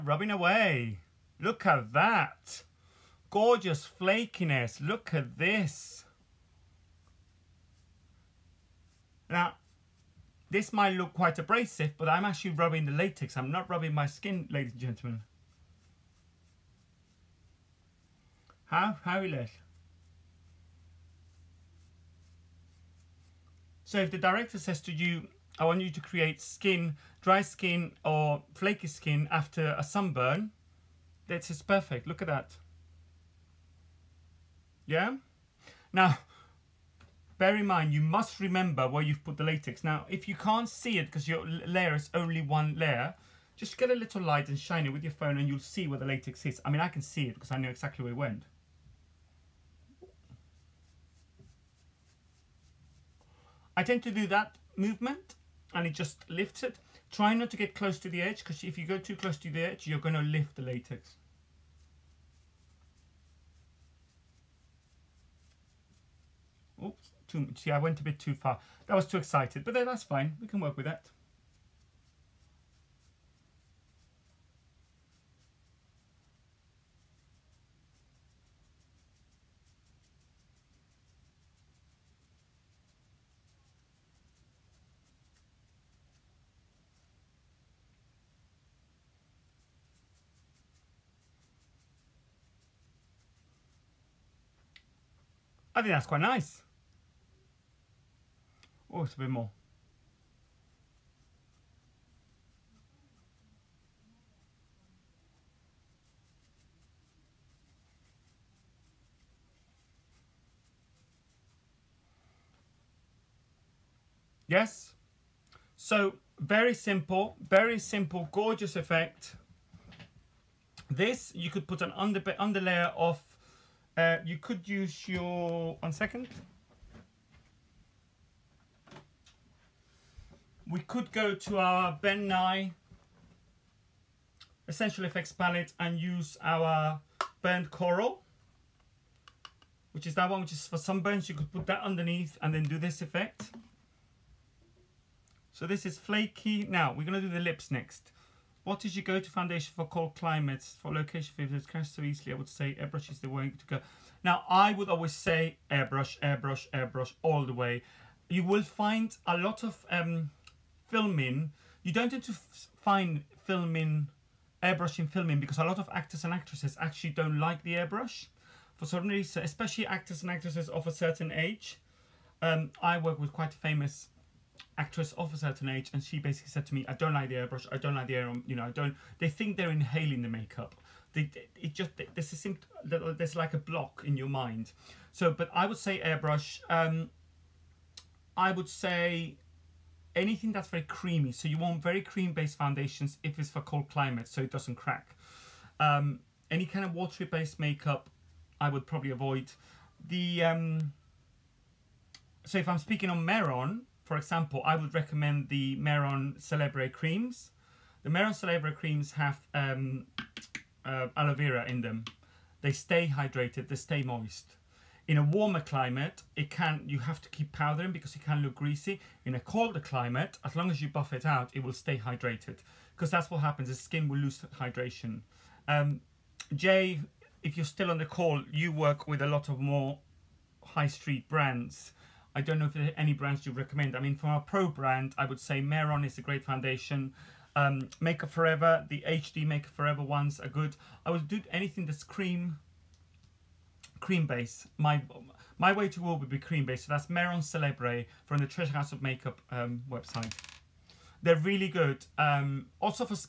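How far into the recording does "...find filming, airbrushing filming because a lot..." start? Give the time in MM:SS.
02:42.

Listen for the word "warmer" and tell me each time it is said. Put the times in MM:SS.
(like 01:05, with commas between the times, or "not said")
03:35.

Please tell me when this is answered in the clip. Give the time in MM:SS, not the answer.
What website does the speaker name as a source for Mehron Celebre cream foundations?
04:08.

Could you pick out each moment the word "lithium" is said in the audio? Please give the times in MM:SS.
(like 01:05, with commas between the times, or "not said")
not said.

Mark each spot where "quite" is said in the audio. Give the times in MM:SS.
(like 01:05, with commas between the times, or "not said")
00:11, 01:36, 02:53.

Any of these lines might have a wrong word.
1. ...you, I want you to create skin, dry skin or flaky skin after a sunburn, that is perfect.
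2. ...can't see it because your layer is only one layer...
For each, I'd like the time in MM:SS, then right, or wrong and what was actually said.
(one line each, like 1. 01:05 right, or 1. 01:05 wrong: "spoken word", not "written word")
1. 00:24 right
2. 00:40 right.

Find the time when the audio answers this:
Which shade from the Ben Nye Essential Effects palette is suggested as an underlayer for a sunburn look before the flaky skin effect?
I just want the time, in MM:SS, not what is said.
02:17.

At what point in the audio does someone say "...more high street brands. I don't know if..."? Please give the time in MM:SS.
03:49.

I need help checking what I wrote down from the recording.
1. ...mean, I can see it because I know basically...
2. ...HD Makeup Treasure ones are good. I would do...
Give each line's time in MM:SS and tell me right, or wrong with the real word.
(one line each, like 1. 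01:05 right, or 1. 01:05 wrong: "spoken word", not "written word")
1. 00:46 wrong: "exactly", not "basically"
2. 03:59 wrong: "Forever", not "Treasure".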